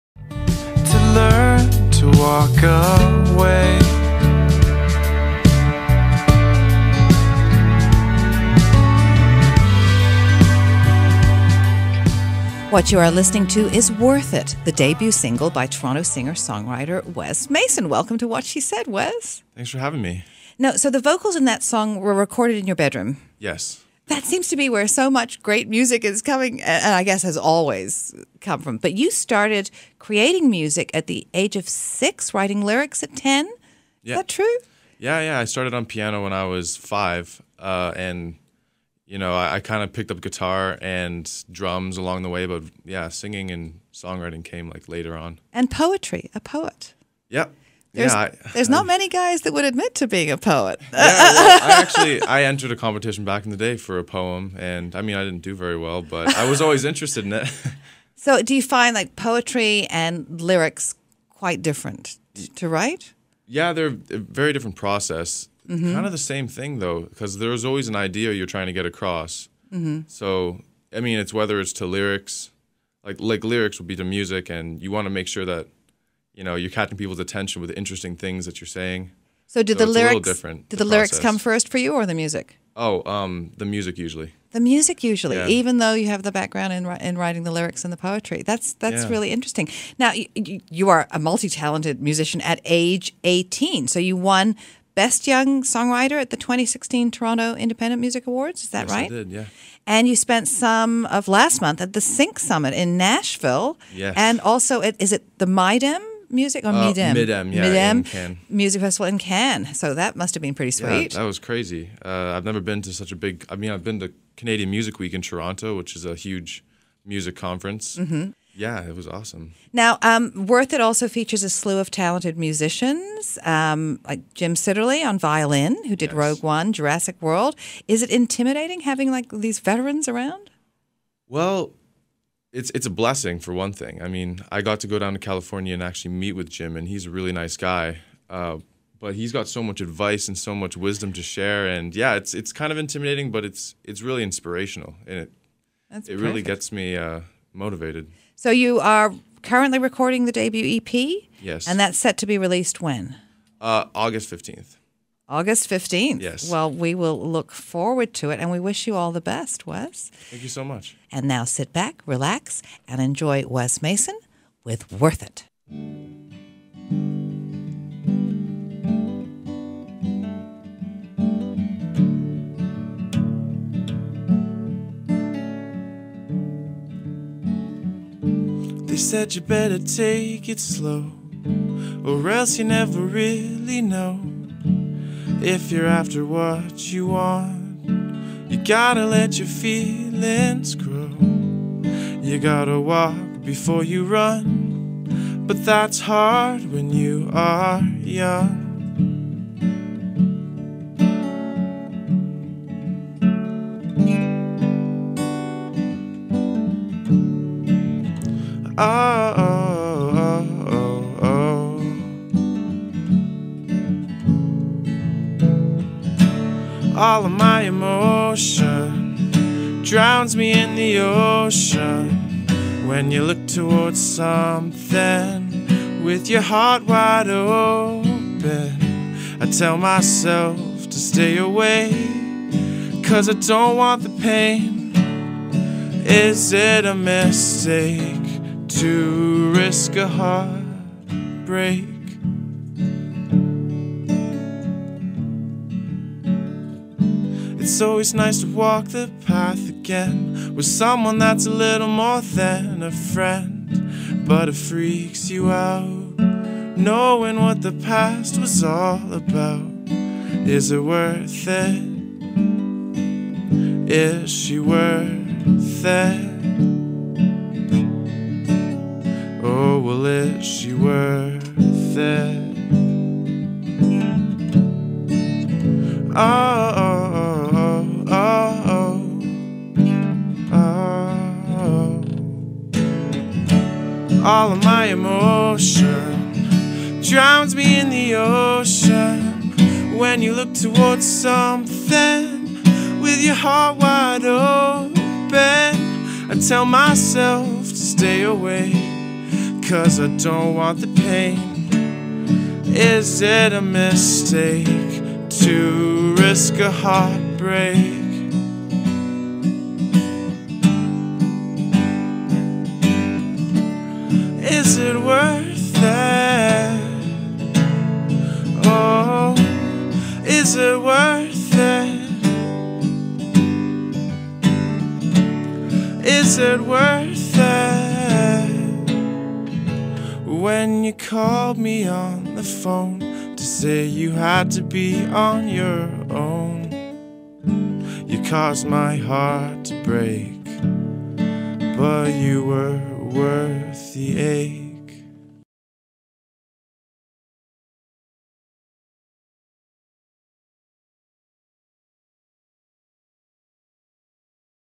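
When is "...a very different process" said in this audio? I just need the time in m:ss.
1:03.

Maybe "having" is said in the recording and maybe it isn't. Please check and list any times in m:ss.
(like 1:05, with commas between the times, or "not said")
0:19, 2:08.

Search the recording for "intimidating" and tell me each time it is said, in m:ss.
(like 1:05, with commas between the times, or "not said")
2:08, 2:22.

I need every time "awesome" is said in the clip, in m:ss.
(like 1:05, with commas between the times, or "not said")
1:59.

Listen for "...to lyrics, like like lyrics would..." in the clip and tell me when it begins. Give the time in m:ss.
1:11.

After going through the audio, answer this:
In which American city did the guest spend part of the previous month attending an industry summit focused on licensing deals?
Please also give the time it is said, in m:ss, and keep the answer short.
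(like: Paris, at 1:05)
Nashville, at 1:42.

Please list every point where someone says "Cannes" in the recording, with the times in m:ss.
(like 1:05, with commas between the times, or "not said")
1:49.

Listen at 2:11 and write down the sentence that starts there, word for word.
Well, it's it's a blessing for one thing.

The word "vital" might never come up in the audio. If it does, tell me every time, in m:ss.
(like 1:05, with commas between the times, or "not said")
not said.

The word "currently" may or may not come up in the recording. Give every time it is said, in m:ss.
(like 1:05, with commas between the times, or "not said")
2:29.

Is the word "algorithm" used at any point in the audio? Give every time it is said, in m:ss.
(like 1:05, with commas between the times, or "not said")
not said.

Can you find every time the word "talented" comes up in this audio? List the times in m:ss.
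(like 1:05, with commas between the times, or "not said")
1:31, 2:01.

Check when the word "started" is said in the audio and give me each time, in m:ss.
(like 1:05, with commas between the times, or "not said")
0:29, 0:35.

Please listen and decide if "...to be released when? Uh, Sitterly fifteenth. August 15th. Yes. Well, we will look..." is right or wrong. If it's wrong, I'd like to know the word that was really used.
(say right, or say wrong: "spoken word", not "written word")
wrong: "August", not "Sitterly".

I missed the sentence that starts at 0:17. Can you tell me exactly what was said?
Welcome to What She Said, Wes.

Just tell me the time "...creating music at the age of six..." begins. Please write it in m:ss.
0:29.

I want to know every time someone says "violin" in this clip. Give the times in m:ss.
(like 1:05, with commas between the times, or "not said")
2:05.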